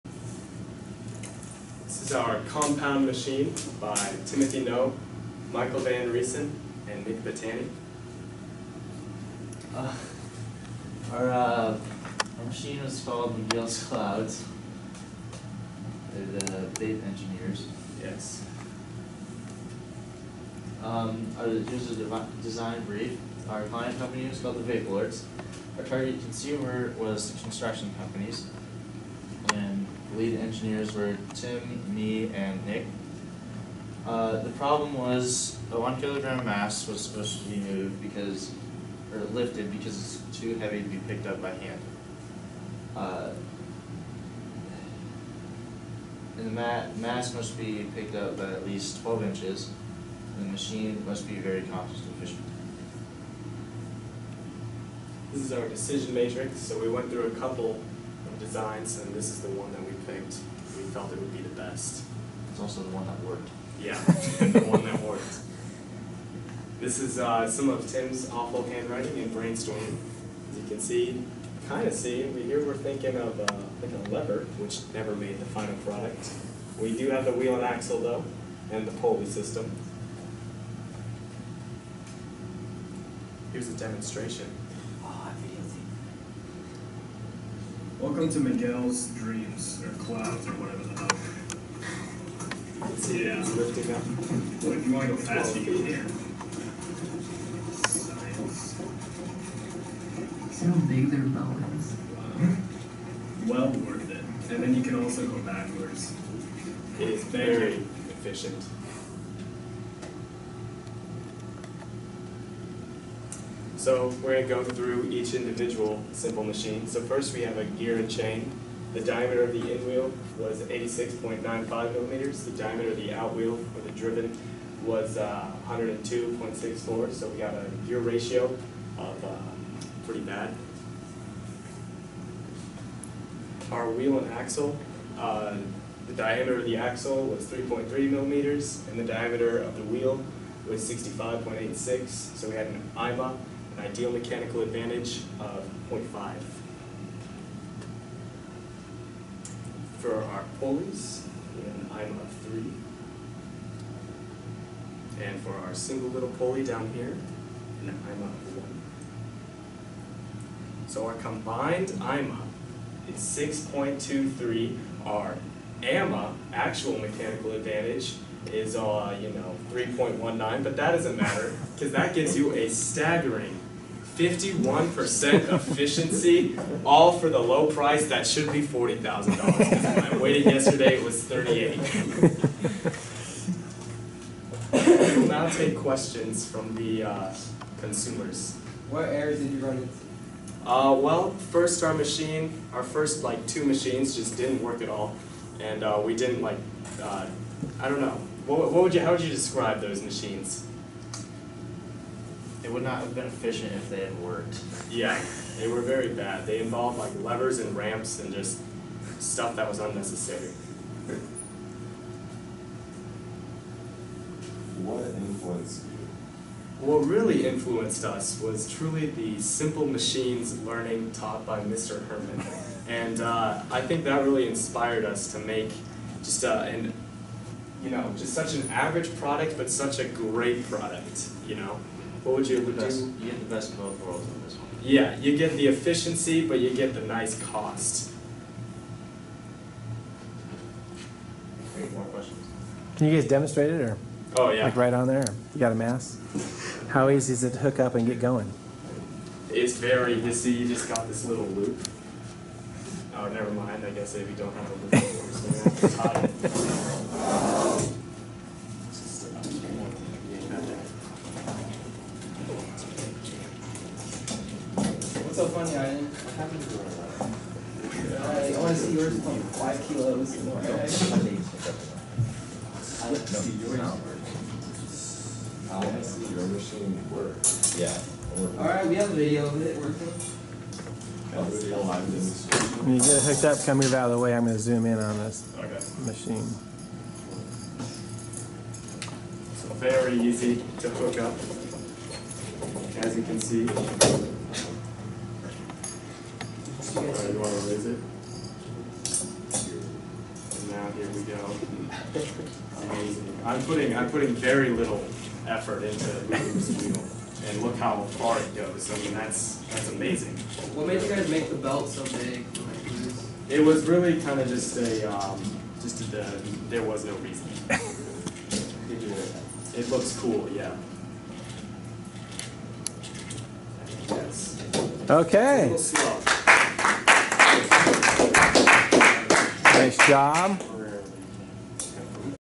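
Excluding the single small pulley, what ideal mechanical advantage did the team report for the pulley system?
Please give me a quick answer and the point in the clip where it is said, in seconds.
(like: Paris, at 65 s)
3, at 151 s.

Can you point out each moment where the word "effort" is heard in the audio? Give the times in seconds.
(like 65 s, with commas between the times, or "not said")
305 s.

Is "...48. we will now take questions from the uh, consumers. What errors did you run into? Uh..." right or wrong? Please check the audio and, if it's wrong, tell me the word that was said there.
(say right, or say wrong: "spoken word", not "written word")
wrong: "38", not "48".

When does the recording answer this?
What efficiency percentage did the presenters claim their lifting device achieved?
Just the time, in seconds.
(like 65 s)
174 s.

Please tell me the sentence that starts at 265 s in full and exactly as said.
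I, I, I want to see yours from five kilos.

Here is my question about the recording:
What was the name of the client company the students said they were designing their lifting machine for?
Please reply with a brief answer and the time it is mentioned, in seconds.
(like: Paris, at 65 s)
Vape Lords, at 24 s.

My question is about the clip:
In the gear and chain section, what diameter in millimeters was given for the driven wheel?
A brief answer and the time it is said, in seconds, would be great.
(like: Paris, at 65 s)
102.64, at 125 s.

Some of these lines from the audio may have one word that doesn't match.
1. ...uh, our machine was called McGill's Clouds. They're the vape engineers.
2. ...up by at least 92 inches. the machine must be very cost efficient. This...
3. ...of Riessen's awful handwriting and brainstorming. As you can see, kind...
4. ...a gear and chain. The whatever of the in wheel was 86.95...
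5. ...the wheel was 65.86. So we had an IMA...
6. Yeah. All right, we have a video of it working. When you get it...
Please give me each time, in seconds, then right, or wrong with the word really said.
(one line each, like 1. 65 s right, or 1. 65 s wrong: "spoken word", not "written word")
1. 11 s right
2. 48 s wrong: "12", not "92"
3. 67 s wrong: "Tim", not "Riessen"
4. 117 s wrong: "diameter", not "whatever"
5. 139 s right
6. 277 s right.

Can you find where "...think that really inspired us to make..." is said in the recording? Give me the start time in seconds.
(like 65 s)
223 s.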